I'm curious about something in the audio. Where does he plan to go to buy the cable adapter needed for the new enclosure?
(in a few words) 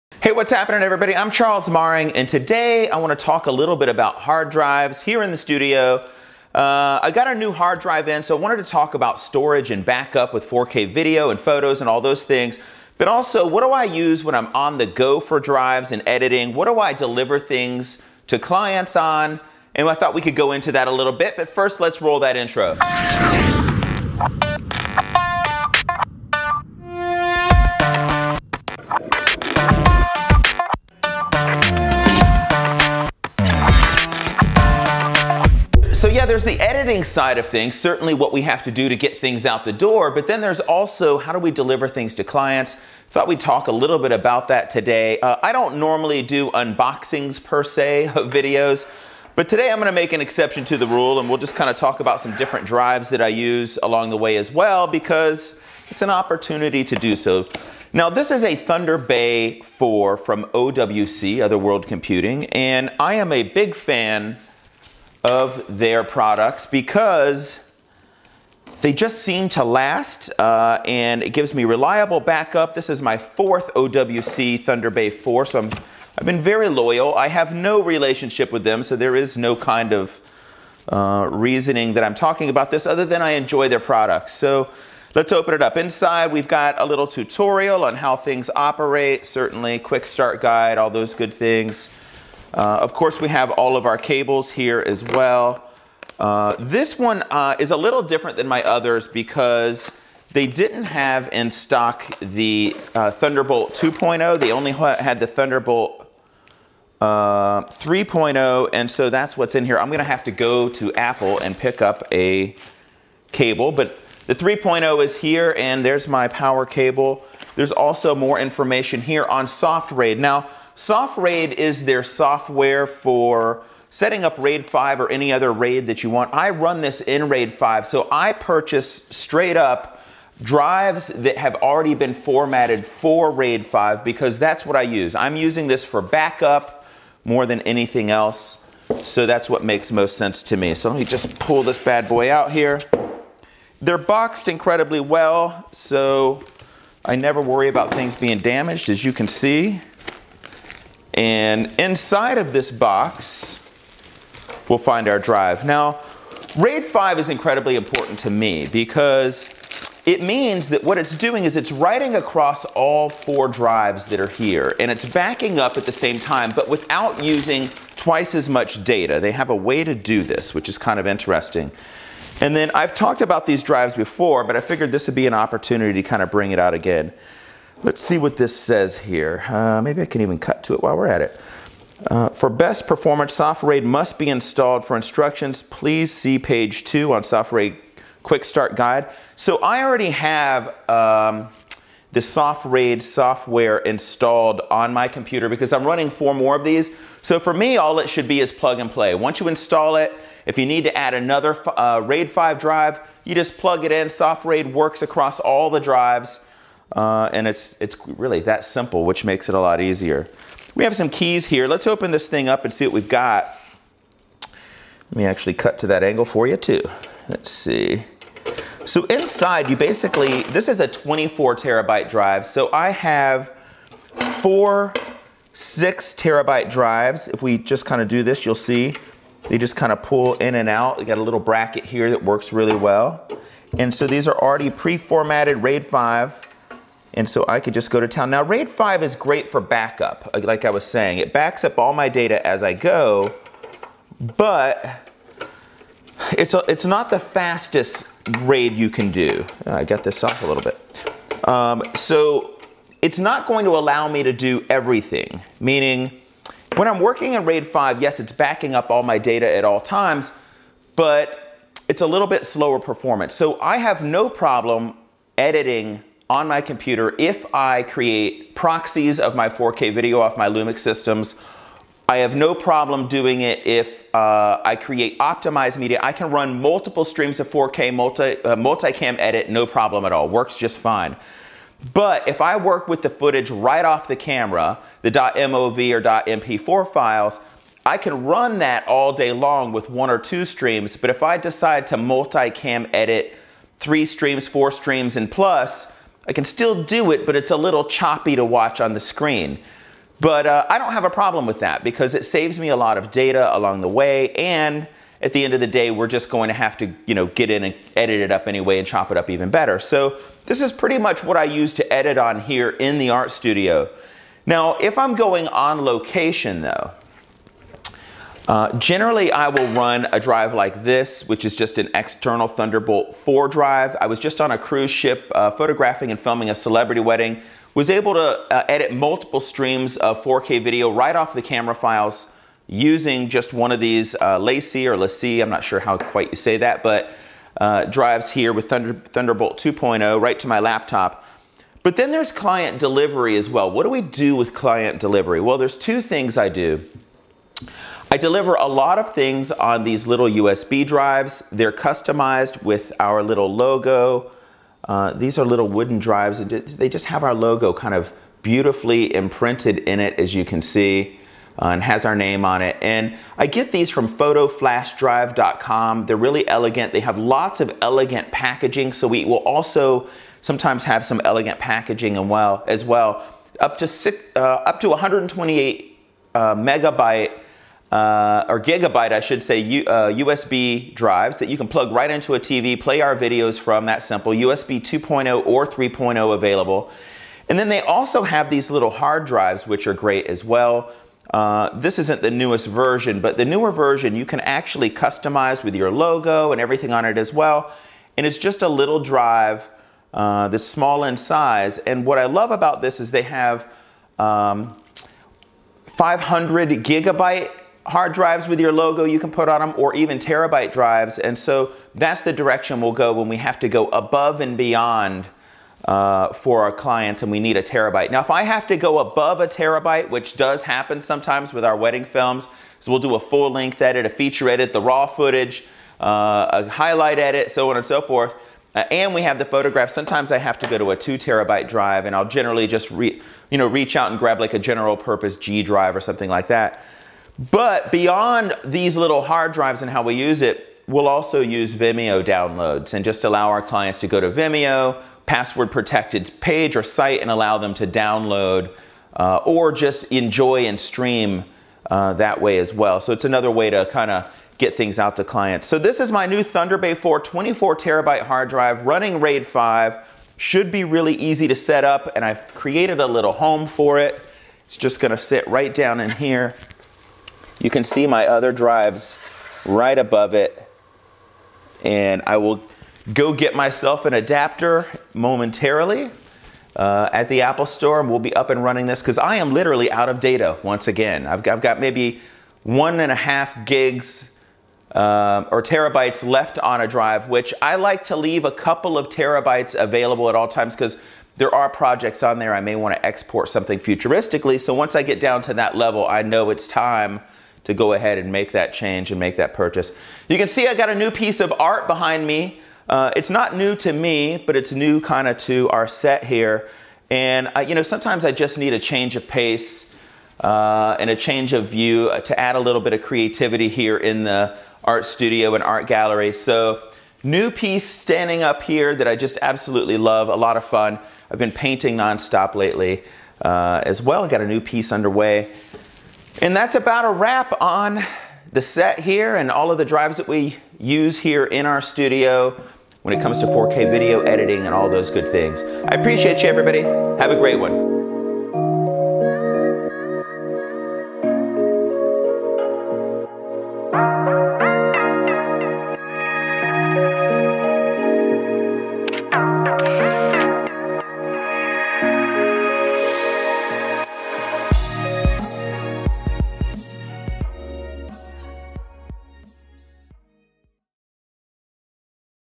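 Apple Store.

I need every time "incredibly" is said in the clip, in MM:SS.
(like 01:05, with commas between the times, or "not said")
02:24, 02:37.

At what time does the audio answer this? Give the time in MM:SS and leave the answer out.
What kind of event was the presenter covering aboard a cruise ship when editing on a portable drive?
05:26.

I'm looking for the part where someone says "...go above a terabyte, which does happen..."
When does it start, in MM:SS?
06:58.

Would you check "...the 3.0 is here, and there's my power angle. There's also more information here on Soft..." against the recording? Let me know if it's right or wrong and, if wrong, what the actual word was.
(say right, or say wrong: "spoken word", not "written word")
wrong: "cable", not "angle".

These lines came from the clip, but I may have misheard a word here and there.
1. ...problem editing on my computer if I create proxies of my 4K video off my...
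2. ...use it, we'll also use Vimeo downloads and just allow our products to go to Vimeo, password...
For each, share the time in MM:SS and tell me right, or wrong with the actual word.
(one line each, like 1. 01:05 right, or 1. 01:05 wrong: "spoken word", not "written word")
1. 04:24 right
2. 07:20 wrong: "clients", not "products".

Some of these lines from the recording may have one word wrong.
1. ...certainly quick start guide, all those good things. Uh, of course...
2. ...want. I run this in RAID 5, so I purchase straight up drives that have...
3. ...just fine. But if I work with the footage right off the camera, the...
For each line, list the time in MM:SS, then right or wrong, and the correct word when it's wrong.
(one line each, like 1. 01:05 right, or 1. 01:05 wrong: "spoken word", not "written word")
1. 01:29 right
2. 02:06 right
3. 04:40 right.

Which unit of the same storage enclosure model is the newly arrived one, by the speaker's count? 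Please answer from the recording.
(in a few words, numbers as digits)
fourth.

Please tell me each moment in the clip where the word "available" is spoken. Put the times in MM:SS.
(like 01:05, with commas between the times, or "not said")
06:26, 08:09.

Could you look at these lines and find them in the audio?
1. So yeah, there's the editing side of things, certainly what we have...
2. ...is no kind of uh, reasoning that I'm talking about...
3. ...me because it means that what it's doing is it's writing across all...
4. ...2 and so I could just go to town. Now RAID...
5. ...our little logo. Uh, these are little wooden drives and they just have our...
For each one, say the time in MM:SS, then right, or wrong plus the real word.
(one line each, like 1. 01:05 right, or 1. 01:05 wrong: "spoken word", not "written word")
1. 00:36 right
2. 01:19 right
3. 02:38 right
4. 03:55 wrong: "5", not "2"
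5. 05:52 right.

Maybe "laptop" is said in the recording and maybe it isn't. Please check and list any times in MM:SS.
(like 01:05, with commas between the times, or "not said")
05:40.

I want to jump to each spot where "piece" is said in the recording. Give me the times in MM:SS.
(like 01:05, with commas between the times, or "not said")
08:21, 08:37, 08:44.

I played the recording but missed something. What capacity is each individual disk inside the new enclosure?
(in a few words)
6 terabytes.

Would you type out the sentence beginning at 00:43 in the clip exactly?
Thought we'd talk a little bit about that today.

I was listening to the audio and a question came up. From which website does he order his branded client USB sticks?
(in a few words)
photoflashdrive.com.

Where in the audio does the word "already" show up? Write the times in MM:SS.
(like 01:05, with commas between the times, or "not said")
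02:11, 03:09, 03:54.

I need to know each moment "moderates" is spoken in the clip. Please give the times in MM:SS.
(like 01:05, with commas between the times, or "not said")
not said.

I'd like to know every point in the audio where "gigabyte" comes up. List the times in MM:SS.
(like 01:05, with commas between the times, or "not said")
06:18, 06:46.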